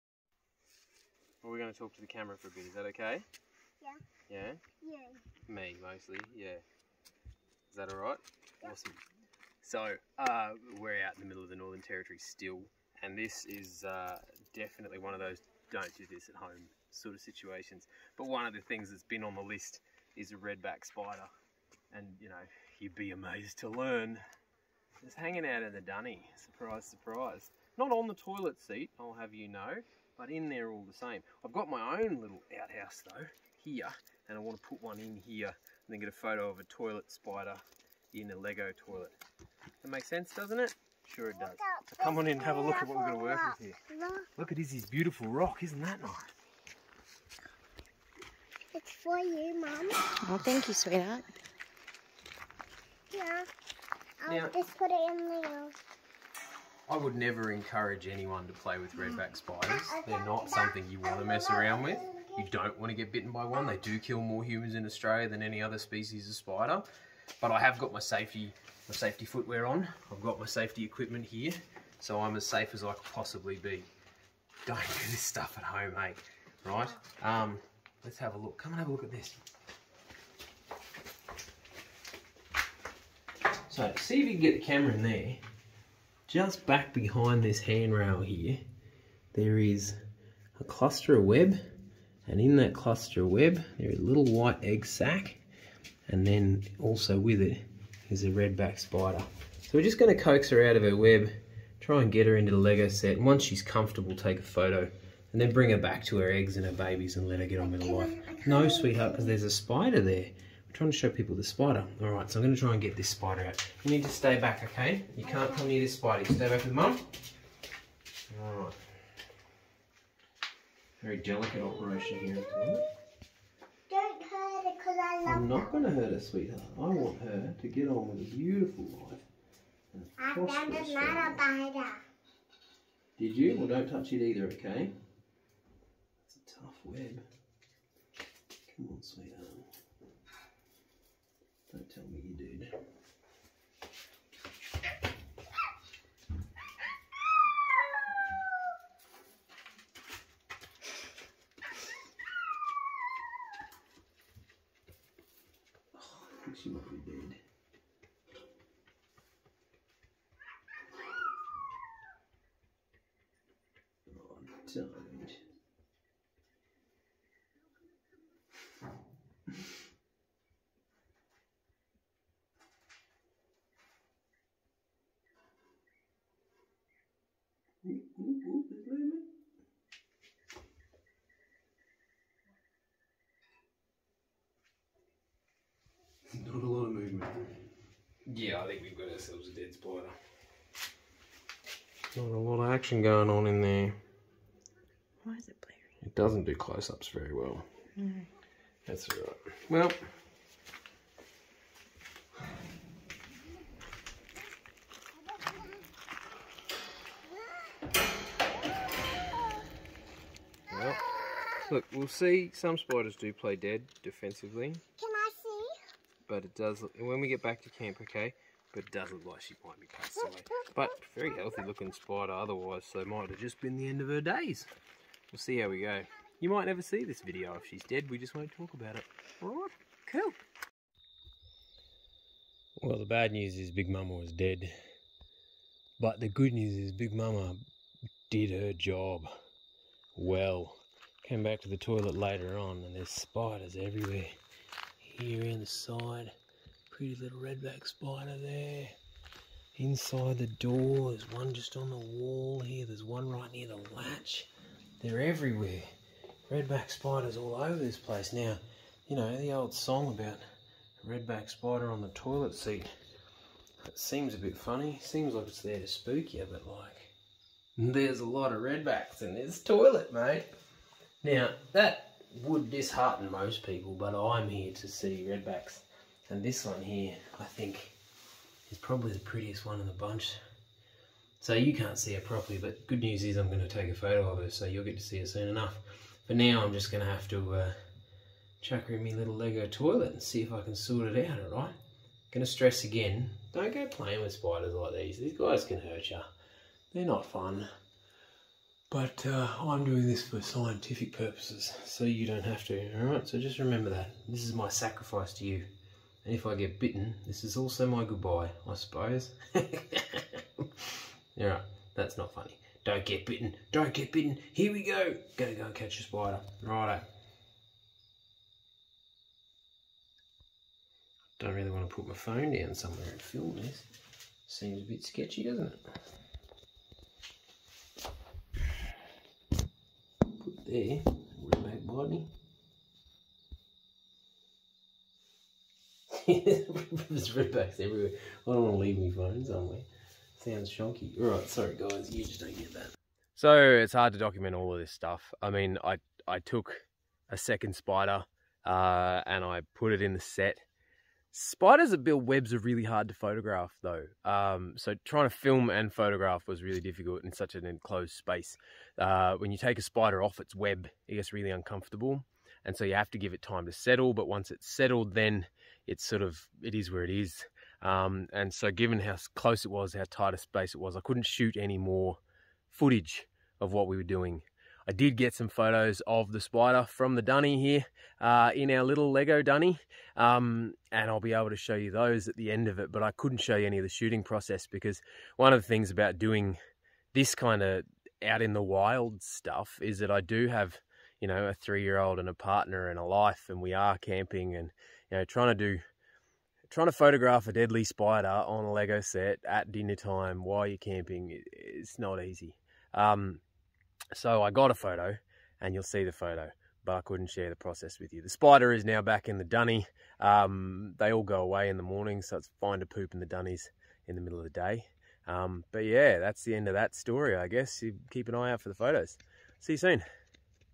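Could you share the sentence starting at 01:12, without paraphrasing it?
So I'm as safe as I could possibly be.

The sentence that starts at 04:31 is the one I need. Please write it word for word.
Now, that would dishearten most people, but I'm here to see redbacks.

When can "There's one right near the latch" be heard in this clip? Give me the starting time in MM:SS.
04:12.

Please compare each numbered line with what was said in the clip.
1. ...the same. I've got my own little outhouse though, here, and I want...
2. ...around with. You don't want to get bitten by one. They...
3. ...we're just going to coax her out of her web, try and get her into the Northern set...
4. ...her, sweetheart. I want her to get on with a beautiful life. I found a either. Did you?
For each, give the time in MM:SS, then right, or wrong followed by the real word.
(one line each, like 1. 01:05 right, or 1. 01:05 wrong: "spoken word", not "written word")
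1. 00:30 right
2. 01:01 right
3. 01:39 wrong: "Lego", not "Northern"
4. 02:06 wrong: "spider", not "either".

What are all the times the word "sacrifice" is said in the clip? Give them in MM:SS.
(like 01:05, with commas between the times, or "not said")
05:04.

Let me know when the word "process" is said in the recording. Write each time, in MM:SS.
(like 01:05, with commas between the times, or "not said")
06:24, 06:47.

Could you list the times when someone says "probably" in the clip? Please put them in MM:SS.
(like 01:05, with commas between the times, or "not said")
04:38.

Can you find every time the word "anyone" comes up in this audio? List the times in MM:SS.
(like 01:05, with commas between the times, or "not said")
00:58.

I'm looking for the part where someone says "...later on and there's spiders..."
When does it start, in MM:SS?
04:02.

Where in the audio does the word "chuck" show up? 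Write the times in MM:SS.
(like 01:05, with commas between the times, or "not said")
04:48.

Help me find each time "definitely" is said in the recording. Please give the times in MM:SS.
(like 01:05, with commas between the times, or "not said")
00:14.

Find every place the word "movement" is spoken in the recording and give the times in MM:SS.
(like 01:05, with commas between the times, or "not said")
03:06.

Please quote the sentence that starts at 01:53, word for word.
You need to stay back, okay?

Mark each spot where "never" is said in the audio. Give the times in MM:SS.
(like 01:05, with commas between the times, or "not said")
00:57, 03:46.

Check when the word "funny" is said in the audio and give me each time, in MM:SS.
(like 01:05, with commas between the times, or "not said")
04:24, 05:12.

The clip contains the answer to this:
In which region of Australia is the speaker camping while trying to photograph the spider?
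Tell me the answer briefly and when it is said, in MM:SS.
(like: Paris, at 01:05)
Northern Territory, at 00:11.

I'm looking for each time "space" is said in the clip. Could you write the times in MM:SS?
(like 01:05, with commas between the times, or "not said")
05:58, 06:10.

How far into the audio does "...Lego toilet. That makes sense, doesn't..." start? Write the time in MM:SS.
00:38.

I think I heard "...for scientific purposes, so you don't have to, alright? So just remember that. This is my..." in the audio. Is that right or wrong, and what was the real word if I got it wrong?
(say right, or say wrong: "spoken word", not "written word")
right.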